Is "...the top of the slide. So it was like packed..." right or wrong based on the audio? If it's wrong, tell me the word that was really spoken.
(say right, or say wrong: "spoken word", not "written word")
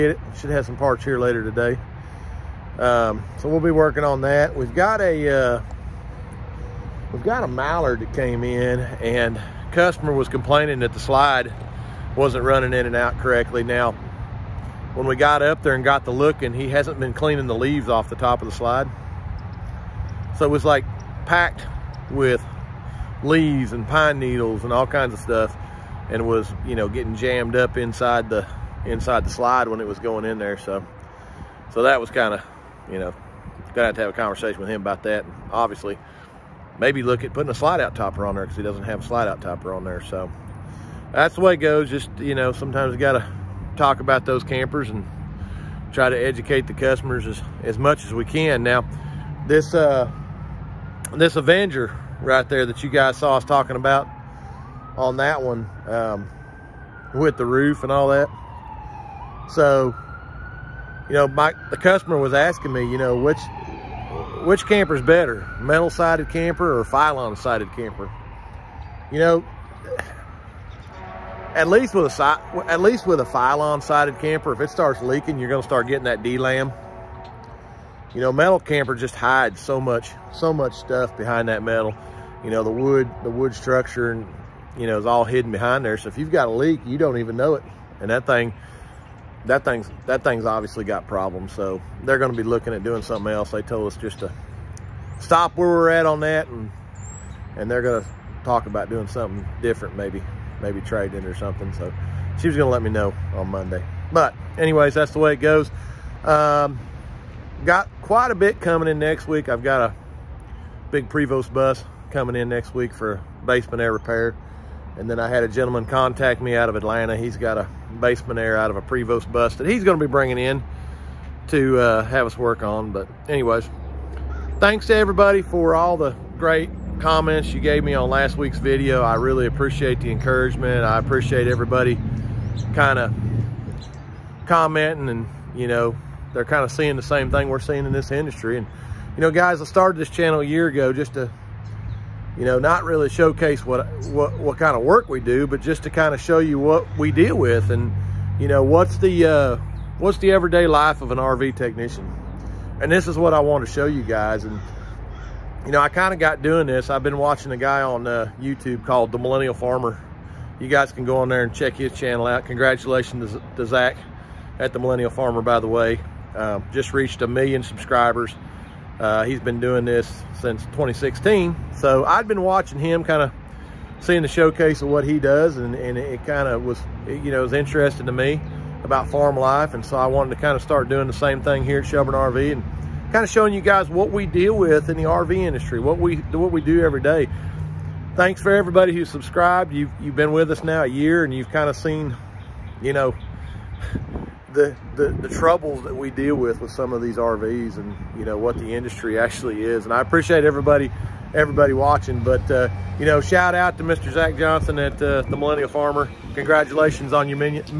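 right.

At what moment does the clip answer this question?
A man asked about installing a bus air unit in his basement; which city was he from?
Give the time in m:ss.
1:56.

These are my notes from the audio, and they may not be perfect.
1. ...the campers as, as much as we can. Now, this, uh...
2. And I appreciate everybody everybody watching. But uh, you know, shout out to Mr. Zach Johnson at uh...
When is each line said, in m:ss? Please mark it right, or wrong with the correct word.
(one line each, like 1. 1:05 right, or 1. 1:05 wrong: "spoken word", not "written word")
1. 0:46 wrong: "customers", not "campers"
2. 3:19 right.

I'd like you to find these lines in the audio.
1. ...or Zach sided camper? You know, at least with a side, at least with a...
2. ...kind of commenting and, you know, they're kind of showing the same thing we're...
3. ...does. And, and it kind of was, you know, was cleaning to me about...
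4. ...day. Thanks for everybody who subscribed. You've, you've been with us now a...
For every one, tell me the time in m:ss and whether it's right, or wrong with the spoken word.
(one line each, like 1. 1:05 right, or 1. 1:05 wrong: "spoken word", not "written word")
1. 1:06 wrong: "Filon", not "Zach"
2. 2:12 wrong: "seeing", not "showing"
3. 2:55 wrong: "interesting", not "cleaning"
4. 3:07 right.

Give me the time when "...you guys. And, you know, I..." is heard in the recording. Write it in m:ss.
2:33.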